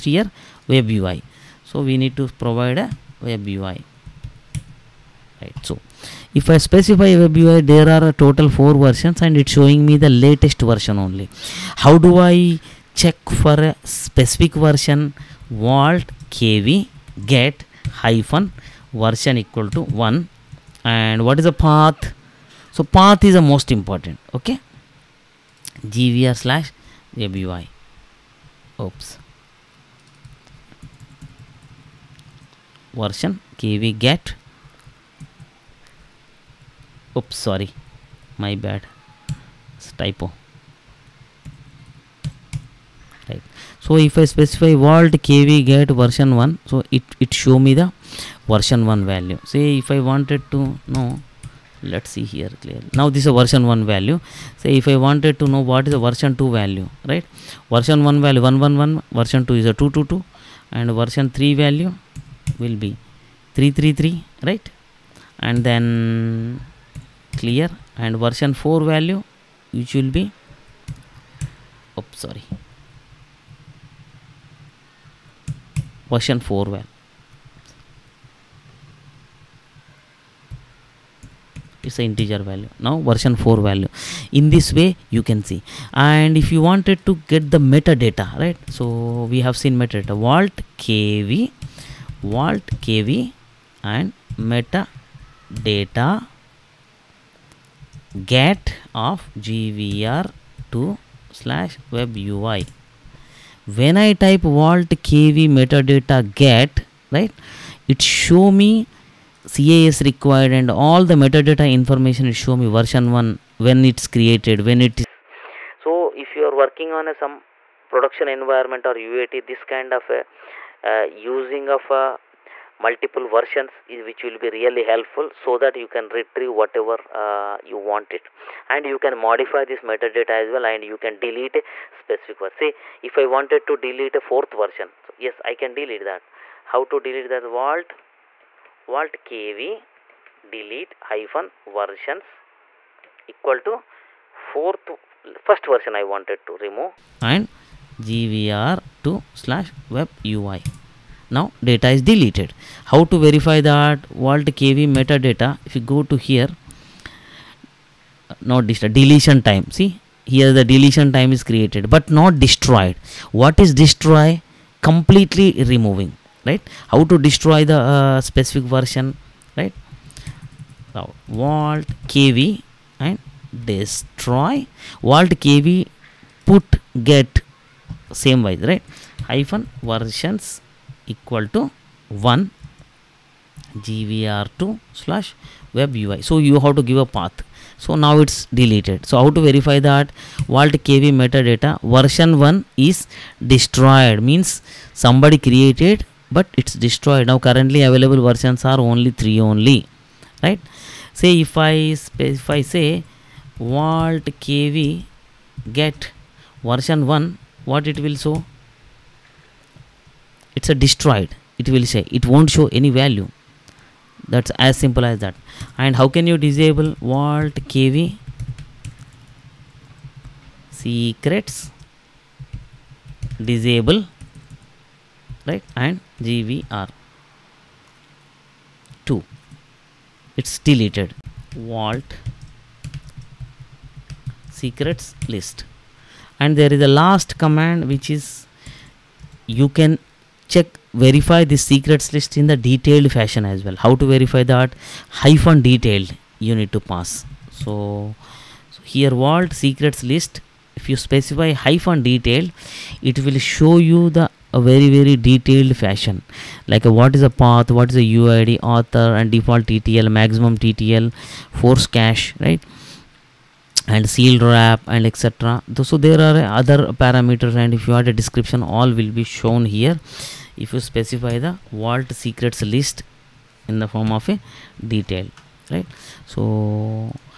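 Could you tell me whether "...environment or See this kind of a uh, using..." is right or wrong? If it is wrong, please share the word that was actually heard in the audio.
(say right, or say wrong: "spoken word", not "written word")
wrong: "UAT", not "See".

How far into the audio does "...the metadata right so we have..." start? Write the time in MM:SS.
01:27.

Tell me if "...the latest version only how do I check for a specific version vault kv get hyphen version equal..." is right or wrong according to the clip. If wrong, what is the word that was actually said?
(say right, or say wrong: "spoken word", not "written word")
right.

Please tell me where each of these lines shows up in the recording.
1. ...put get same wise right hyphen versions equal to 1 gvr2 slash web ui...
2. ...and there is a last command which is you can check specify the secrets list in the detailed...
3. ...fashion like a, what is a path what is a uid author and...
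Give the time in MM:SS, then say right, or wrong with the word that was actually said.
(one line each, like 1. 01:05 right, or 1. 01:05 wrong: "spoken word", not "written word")
1. 02:56 right
2. 03:56 wrong: "verify", not "specify"
3. 04:15 right.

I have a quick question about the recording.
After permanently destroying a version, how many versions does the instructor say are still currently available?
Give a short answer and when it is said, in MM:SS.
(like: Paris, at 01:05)
3, at 03:18.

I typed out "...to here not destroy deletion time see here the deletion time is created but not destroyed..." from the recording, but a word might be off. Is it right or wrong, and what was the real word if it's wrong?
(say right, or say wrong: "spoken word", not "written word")
right.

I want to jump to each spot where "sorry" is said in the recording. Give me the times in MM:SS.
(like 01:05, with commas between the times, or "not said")
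00:37, 01:12.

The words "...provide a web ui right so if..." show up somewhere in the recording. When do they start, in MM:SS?
00:02.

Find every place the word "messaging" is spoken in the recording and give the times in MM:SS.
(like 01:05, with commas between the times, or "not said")
not said.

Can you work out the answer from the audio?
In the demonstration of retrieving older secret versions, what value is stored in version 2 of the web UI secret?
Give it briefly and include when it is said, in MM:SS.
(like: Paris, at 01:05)
222, at 00:59.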